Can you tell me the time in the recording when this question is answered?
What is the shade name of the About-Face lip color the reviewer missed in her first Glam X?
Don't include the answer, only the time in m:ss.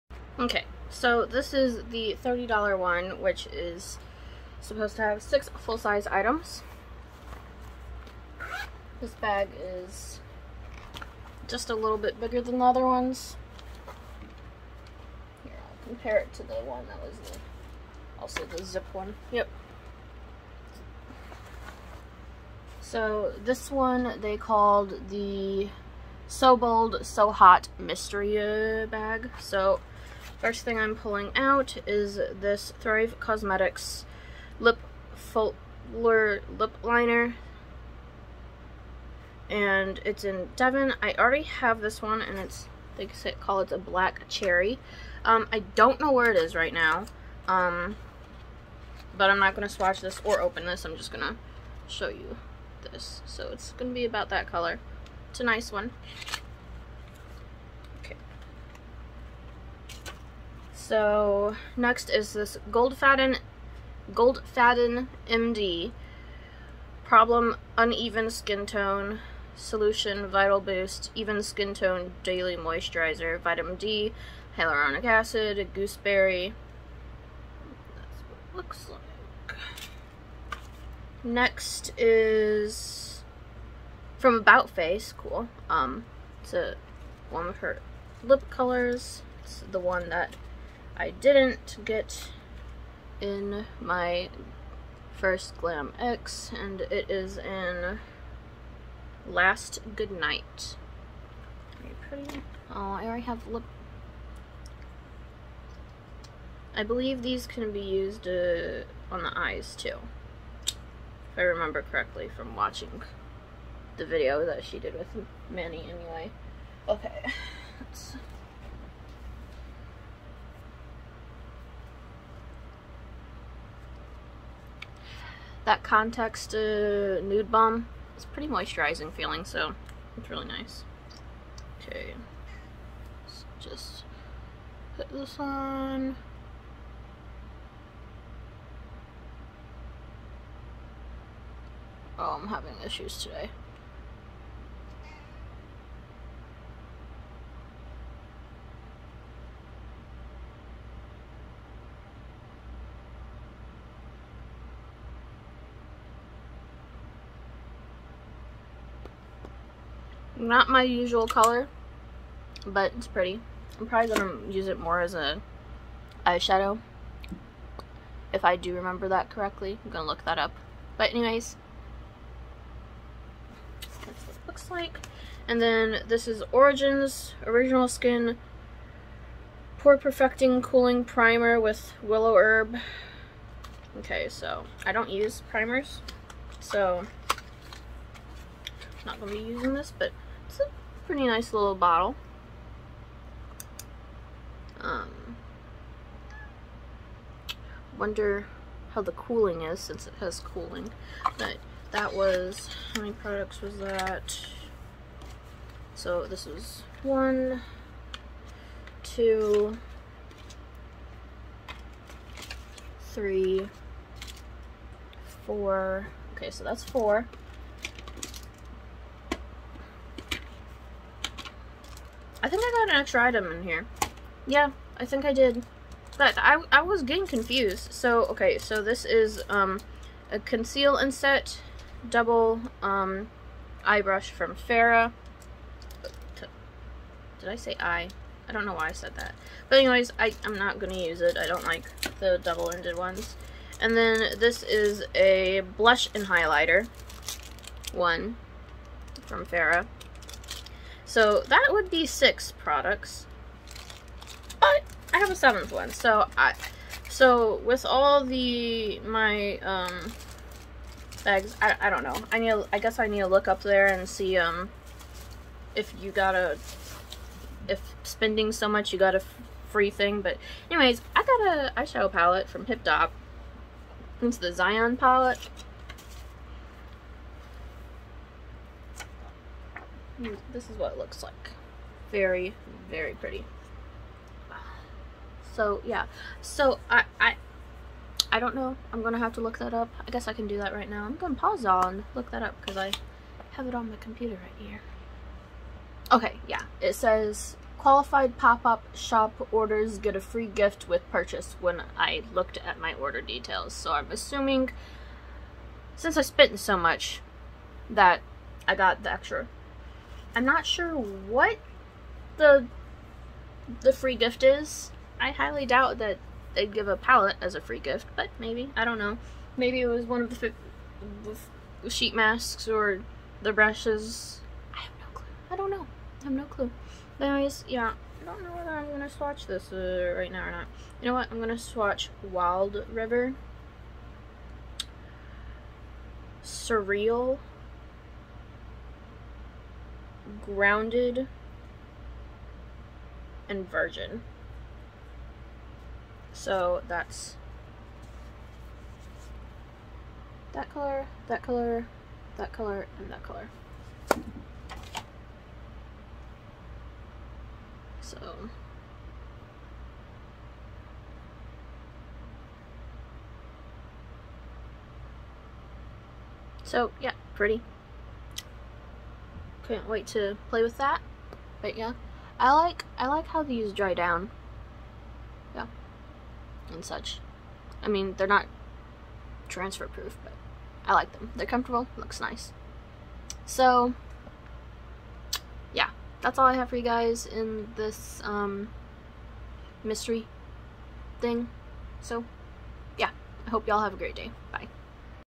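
1:39.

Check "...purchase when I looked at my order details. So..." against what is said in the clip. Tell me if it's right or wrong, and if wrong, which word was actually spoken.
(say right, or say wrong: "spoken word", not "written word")
right.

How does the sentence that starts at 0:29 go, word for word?
So First thing I'm pulling out is this Thrive Causemetics Lip Fuller Lip Liner.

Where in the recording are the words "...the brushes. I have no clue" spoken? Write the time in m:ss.
5:23.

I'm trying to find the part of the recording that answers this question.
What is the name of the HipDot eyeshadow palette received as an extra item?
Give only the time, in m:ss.
4:34.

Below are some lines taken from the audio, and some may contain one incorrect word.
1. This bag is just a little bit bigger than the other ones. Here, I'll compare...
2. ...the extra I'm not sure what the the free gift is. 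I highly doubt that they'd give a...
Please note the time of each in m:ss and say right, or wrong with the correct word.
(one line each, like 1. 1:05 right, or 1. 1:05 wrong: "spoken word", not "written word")
1. 0:08 right
2. 5:09 right.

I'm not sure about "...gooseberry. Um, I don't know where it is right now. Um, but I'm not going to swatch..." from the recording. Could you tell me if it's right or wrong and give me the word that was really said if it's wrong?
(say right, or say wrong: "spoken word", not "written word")
wrong: "cherry", not "gooseberry".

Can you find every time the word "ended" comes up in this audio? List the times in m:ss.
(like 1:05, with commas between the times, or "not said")
4:02.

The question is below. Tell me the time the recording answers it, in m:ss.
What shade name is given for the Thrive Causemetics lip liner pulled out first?
0:40.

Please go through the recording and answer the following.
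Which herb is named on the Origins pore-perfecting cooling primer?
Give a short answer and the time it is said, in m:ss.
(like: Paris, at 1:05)
Willow Herb, at 3:02.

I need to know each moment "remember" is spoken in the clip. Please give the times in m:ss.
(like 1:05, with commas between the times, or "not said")
1:51, 2:48.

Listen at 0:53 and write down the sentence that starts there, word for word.
So it's going to be about that color.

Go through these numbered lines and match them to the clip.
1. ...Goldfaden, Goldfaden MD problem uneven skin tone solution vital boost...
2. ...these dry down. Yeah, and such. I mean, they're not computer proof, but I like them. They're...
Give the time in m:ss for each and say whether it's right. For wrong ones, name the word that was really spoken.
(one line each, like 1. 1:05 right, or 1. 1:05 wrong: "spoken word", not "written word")
1. 1:02 right
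2. 6:13 wrong: "transfer", not "computer".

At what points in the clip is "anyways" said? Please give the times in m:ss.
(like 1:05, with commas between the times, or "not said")
1:55, 2:51, 3:59, 4:30, 5:27.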